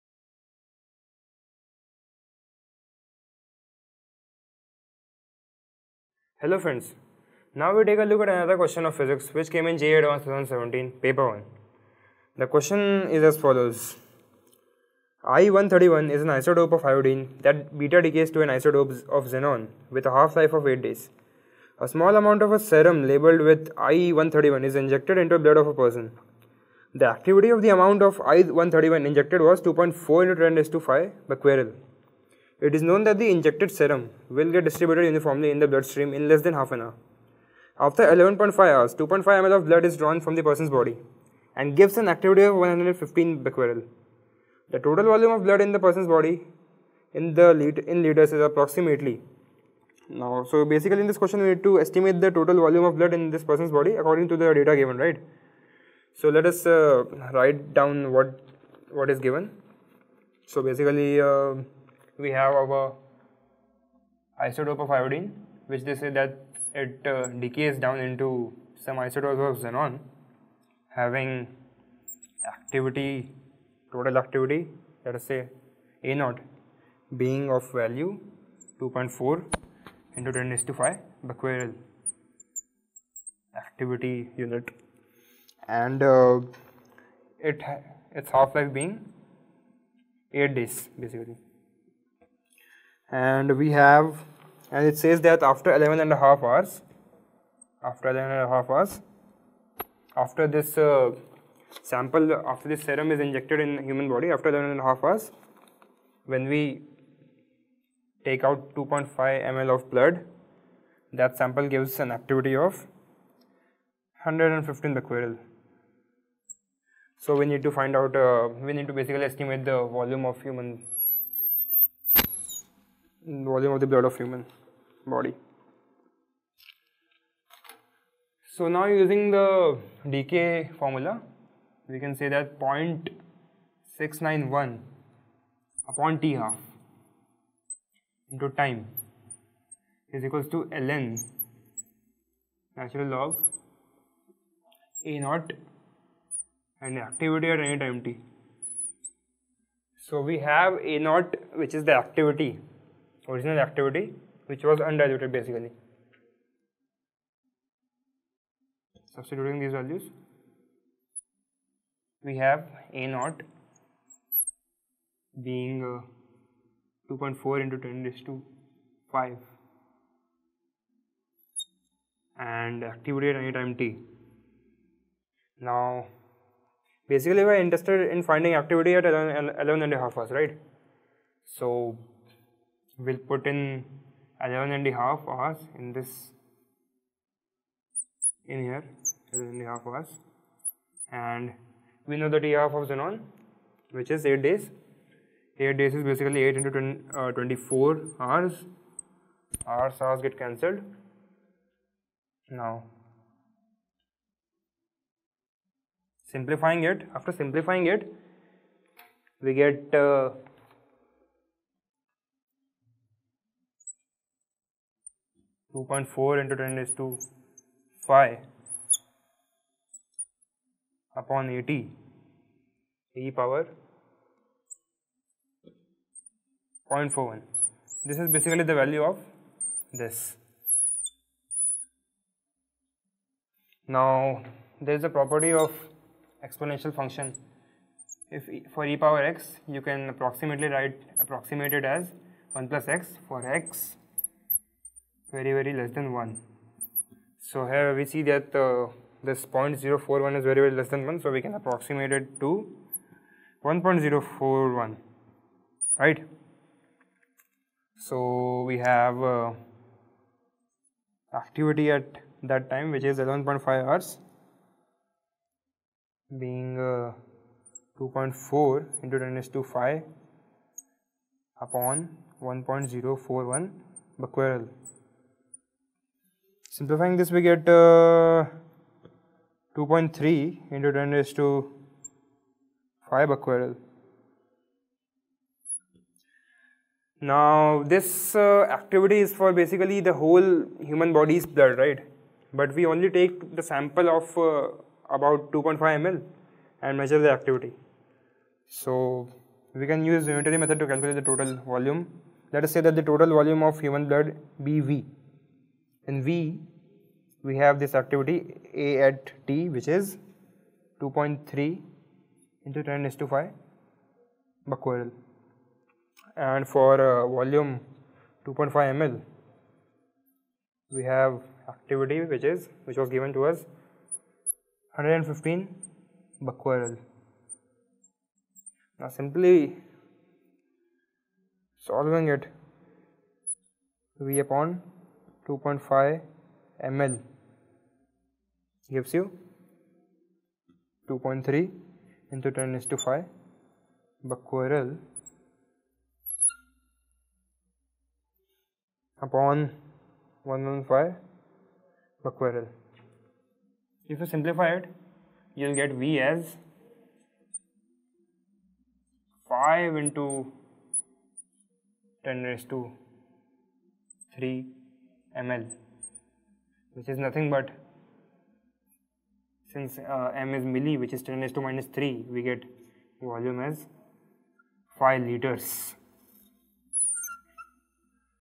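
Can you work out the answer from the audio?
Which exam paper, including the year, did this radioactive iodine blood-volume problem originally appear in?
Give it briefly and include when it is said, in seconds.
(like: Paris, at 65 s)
JEE Advanced 2017, at 9 s.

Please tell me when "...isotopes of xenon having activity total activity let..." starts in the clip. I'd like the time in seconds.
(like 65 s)
68 s.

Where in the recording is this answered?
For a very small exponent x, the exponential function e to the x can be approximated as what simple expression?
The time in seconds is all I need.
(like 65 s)
242 s.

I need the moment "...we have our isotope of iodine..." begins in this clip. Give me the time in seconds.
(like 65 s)
62 s.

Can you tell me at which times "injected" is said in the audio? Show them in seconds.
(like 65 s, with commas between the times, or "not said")
24 s, 29 s, 33 s, 103 s.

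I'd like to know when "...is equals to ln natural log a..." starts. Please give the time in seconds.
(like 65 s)
140 s.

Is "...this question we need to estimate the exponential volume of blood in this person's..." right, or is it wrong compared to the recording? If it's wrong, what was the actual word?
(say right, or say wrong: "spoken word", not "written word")
wrong: "total", not "exponential".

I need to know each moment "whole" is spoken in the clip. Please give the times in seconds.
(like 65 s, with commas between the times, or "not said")
290 s.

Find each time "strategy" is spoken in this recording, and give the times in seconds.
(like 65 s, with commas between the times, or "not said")
not said.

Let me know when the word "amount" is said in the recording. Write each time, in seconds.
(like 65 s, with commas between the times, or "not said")
22 s, 27 s.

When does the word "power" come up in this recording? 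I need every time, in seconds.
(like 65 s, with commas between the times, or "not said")
223 s, 239 s.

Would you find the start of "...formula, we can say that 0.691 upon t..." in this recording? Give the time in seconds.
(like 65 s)
130 s.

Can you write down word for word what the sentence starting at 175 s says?
Now, basically we are interested in finding activity at 11, 11 and a half hours, right?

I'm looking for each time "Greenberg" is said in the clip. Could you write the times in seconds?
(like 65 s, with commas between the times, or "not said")
not said.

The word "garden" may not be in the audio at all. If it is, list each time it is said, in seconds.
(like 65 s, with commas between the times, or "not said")
not said.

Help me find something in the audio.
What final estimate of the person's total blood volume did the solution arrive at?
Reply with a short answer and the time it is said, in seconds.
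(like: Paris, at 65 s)
5 liters, at 374 s.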